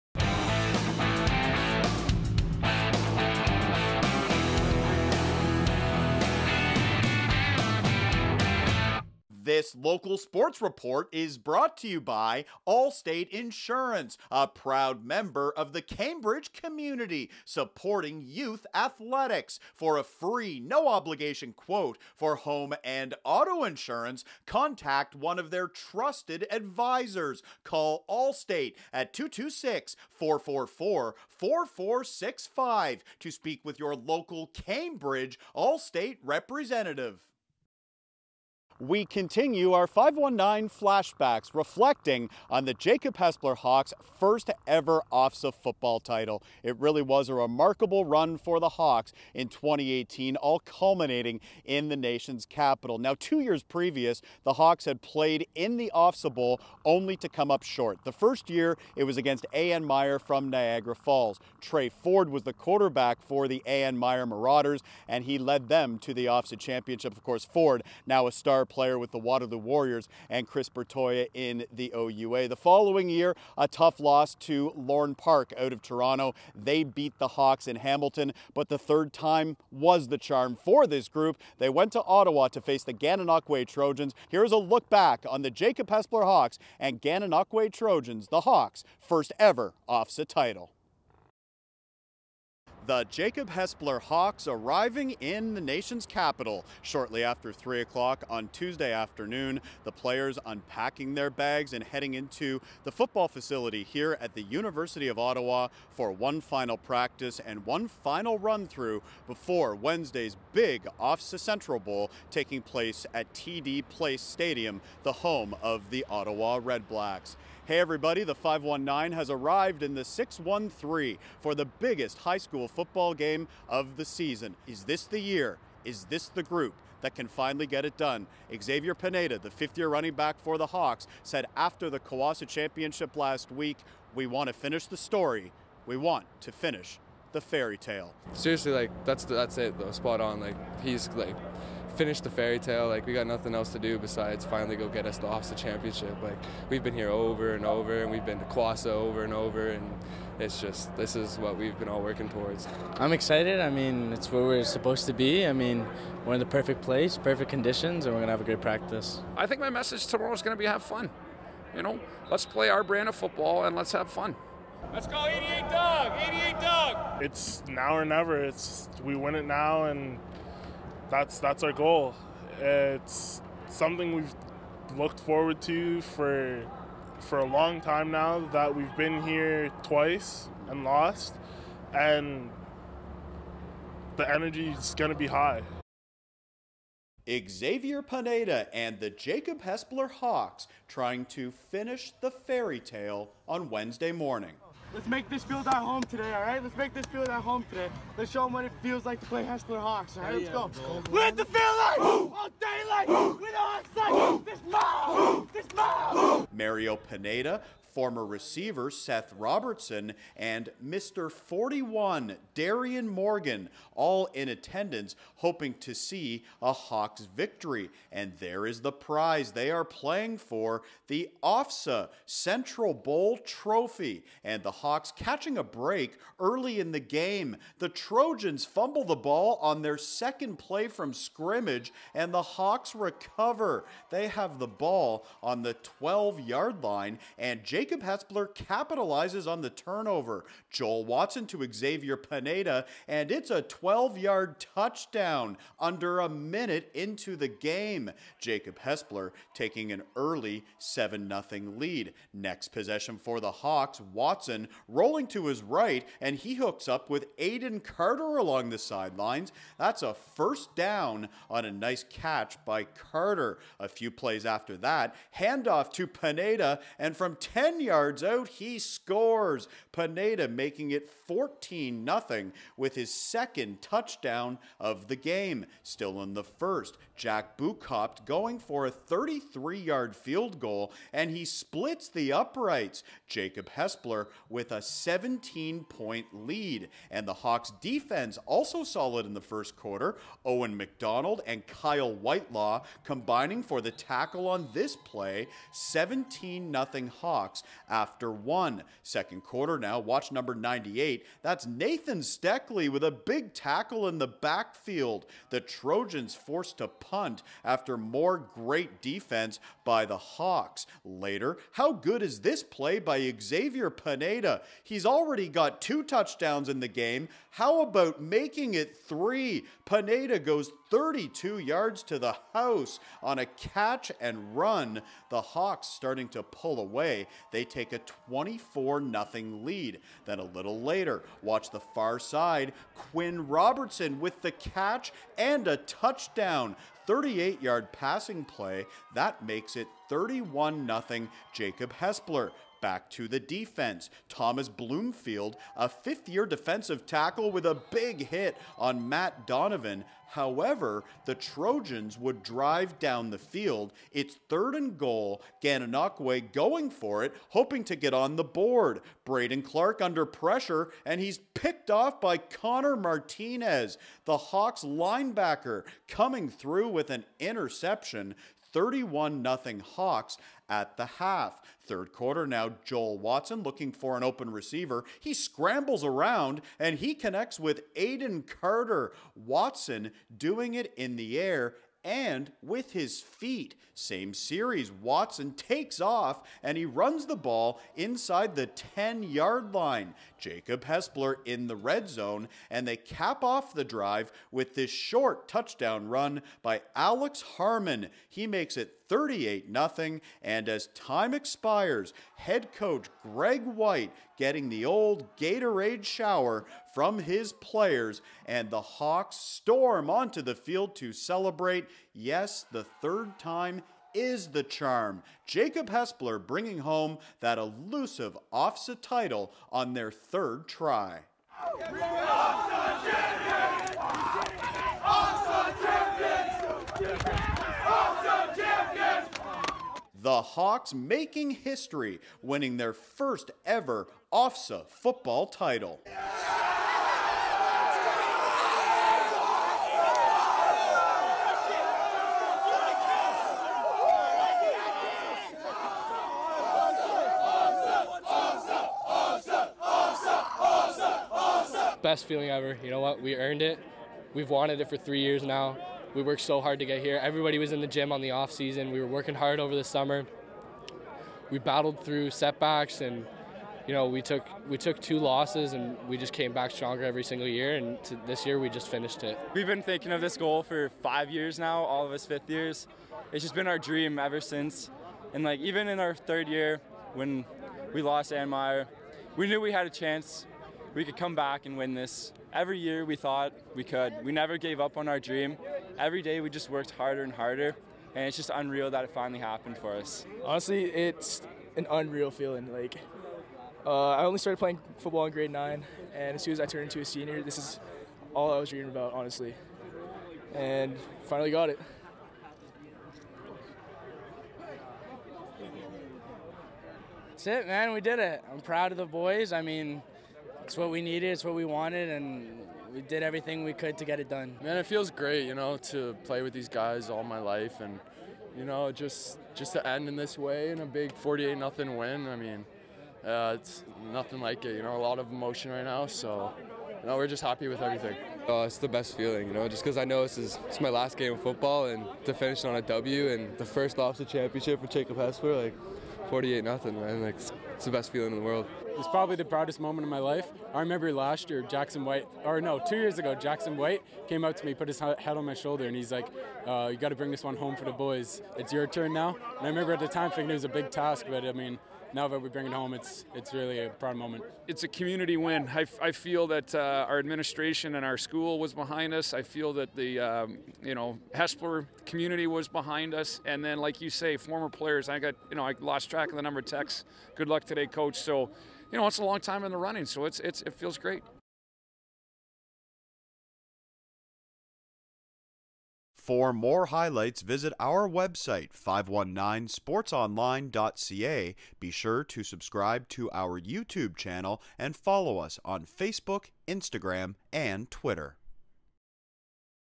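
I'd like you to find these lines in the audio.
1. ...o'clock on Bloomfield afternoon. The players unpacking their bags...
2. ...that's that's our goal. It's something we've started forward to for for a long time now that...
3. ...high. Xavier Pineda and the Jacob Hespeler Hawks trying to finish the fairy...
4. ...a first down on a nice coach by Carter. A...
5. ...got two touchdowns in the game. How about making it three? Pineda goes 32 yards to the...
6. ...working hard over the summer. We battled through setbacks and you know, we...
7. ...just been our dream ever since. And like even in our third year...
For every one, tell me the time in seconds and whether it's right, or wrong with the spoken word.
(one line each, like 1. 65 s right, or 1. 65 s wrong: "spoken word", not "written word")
1. 97 s wrong: "Tuesday", not "Bloomfield"
2. 171 s wrong: "looked", not "started"
3. 185 s right
4. 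260 s wrong: "catch", not "coach"
5. 315 s right
6. 459 s right
7. 473 s right.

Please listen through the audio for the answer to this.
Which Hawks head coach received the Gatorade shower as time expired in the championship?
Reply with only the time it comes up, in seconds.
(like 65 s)
403 s.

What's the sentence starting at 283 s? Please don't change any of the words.
Jacob Hespeler with a 17 point lead.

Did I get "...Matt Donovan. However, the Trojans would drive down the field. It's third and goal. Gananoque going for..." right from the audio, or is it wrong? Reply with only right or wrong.
right.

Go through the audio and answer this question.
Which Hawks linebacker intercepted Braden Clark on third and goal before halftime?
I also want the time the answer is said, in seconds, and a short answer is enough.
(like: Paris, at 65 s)
Connor Martinez, at 362 s.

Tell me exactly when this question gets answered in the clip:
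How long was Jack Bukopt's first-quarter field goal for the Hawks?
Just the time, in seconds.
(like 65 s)
278 s.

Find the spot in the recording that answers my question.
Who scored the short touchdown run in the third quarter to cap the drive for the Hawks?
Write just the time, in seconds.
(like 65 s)
396 s.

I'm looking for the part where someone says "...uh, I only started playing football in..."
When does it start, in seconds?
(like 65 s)
493 s.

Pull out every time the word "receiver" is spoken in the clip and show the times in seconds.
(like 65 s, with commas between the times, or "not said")
208 s, 374 s.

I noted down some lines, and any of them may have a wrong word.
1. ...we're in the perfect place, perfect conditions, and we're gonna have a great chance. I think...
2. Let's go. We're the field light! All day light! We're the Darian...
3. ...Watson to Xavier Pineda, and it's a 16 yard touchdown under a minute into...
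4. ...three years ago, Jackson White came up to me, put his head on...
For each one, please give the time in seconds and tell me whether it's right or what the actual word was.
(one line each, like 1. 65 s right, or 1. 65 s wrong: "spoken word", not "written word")
1. 156 s wrong: "practice", not "chance"
2. 200 s wrong: "Hawks", not "Darian"
3. 241 s wrong: "12", not "16"
4. 542 s wrong: "two", not "three".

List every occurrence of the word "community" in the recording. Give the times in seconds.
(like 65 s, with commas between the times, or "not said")
16 s, 554 s, 562 s.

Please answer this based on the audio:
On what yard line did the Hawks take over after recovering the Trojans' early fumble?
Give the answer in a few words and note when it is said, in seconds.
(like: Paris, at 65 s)
12, at 235 s.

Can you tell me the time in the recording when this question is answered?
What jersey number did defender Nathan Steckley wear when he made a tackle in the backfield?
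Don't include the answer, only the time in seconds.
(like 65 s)
300 s.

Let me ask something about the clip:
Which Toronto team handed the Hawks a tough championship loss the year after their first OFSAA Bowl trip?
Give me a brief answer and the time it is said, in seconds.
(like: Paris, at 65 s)
Lorne Park, at 74 s.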